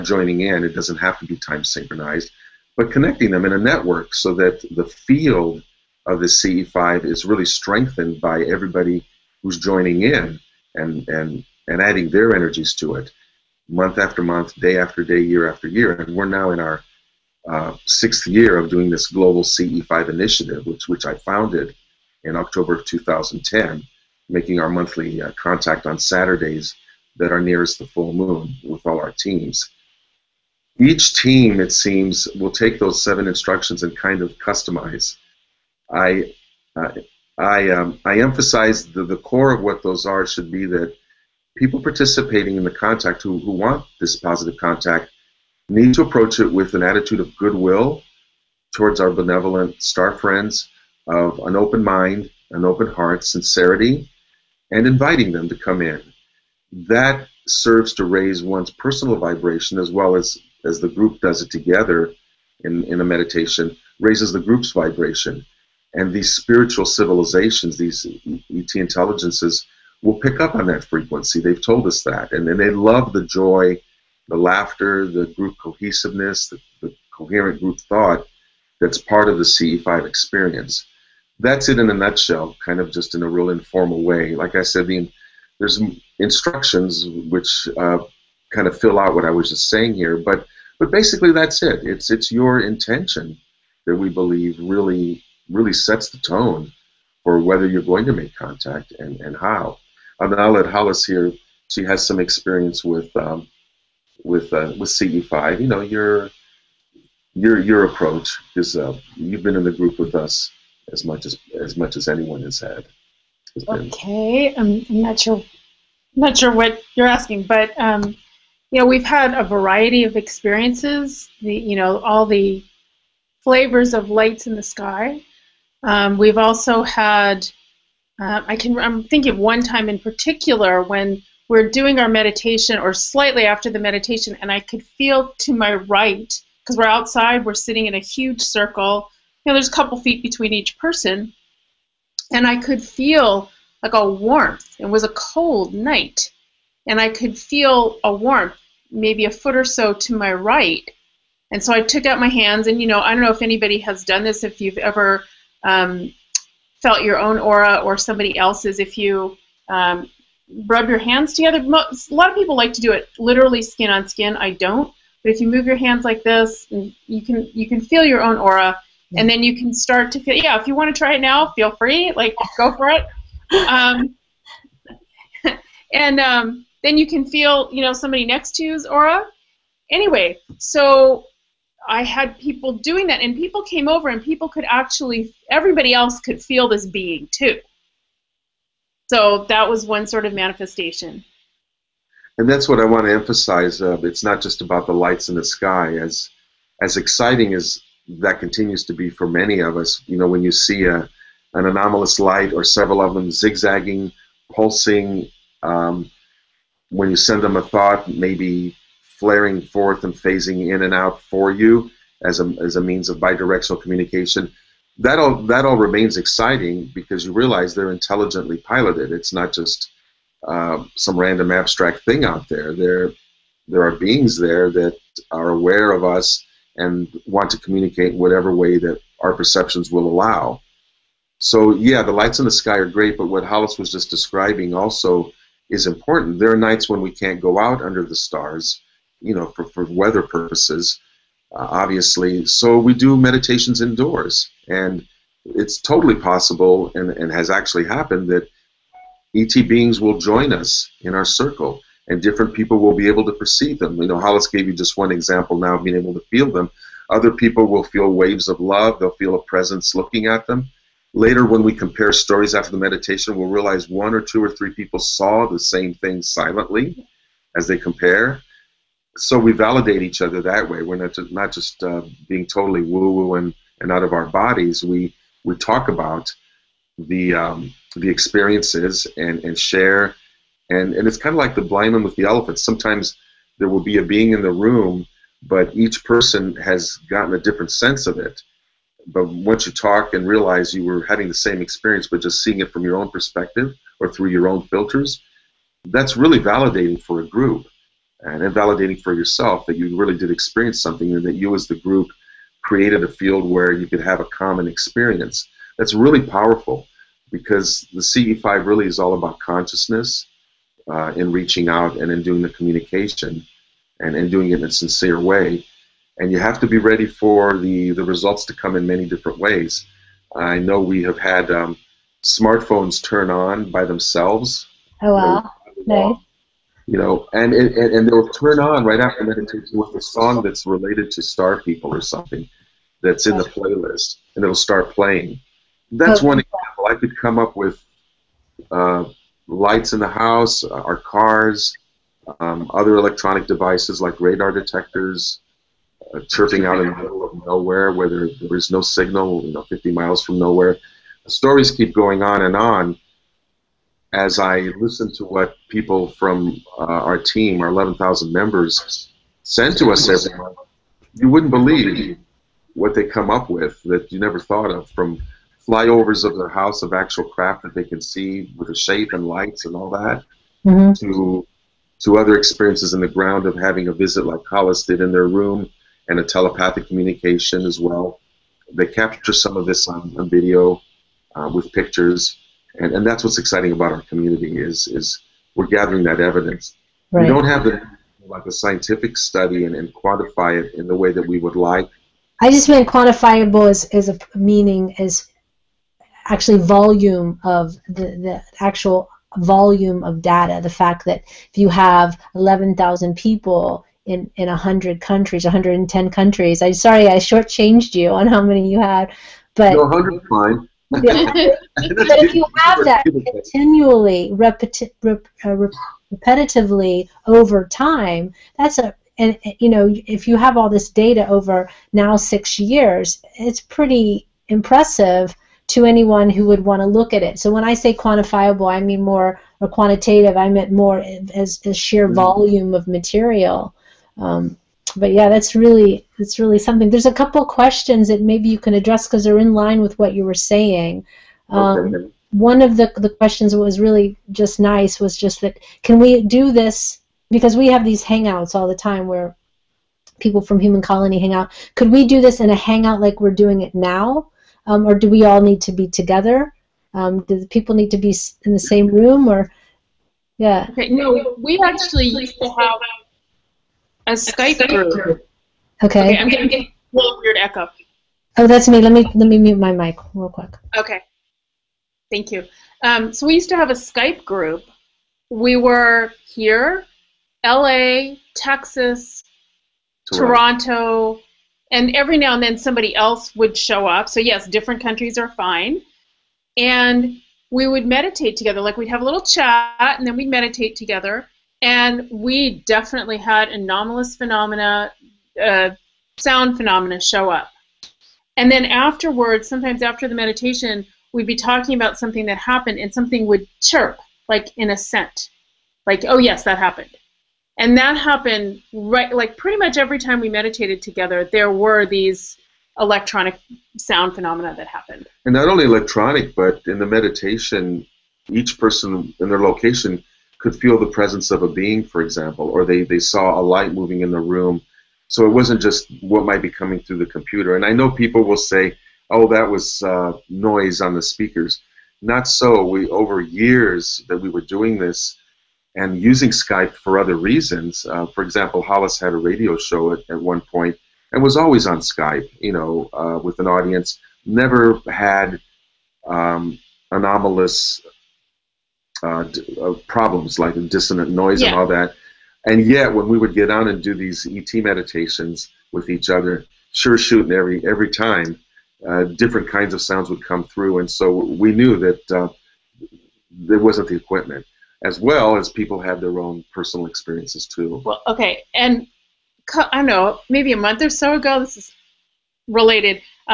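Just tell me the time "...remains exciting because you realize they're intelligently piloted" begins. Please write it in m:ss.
3:35.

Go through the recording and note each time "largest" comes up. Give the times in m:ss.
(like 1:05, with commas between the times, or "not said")
not said.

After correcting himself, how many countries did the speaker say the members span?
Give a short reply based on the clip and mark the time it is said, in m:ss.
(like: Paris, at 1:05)
110, at 6:45.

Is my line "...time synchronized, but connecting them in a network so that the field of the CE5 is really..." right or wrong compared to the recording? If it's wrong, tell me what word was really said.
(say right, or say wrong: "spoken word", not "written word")
right.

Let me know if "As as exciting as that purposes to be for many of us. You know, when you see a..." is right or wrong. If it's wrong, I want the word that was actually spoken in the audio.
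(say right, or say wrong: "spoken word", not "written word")
wrong: "continues", not "purposes".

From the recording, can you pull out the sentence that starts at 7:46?
okay I'm getting, getting a little weird echo.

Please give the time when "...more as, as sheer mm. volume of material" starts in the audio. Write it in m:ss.
7:10.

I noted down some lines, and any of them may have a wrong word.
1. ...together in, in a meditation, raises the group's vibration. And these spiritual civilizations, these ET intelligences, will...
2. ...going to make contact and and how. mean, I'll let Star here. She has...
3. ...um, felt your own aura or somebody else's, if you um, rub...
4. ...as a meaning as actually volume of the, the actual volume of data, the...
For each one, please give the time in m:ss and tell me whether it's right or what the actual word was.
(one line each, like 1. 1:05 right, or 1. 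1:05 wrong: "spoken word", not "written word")
1. 1:01 right
2. 1:37 wrong: "Hollis", not "Star"
3. 2:35 right
4. 6:33 right.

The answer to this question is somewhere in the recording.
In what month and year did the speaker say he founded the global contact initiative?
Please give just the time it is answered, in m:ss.
0:22.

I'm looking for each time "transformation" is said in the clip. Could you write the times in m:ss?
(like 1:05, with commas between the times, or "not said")
not said.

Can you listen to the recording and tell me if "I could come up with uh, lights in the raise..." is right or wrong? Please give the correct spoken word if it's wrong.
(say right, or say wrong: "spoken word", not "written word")
wrong: "house", not "raise".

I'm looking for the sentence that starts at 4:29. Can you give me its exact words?
So we validate each other that way.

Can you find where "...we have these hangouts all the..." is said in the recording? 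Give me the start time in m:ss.
7:27.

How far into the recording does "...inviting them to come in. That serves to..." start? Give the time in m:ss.
0:54.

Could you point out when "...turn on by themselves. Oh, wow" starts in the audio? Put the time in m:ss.
5:23.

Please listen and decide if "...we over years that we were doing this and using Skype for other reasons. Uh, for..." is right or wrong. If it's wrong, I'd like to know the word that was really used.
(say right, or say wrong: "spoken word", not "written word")
right.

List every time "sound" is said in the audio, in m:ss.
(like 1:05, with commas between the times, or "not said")
8:16, 8:33, 9:19.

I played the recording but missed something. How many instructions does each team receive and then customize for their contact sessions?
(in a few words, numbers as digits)
7.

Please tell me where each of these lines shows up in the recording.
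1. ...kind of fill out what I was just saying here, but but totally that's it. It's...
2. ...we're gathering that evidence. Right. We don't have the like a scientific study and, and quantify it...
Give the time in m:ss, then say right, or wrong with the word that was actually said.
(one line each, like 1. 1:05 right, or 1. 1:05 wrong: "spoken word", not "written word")
1. 1:28 wrong: "basically", not "totally"
2. 6:25 right.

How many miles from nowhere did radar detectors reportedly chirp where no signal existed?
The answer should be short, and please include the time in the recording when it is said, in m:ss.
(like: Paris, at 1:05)
50, at 5:49.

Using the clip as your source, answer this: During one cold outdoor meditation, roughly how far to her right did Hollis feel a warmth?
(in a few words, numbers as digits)
a foot.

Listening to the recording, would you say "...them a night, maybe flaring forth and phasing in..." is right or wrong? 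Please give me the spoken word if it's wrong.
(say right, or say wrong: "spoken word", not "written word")
wrong: "thought", not "night".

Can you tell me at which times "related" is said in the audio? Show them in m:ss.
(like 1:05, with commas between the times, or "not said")
5:30, 9:32.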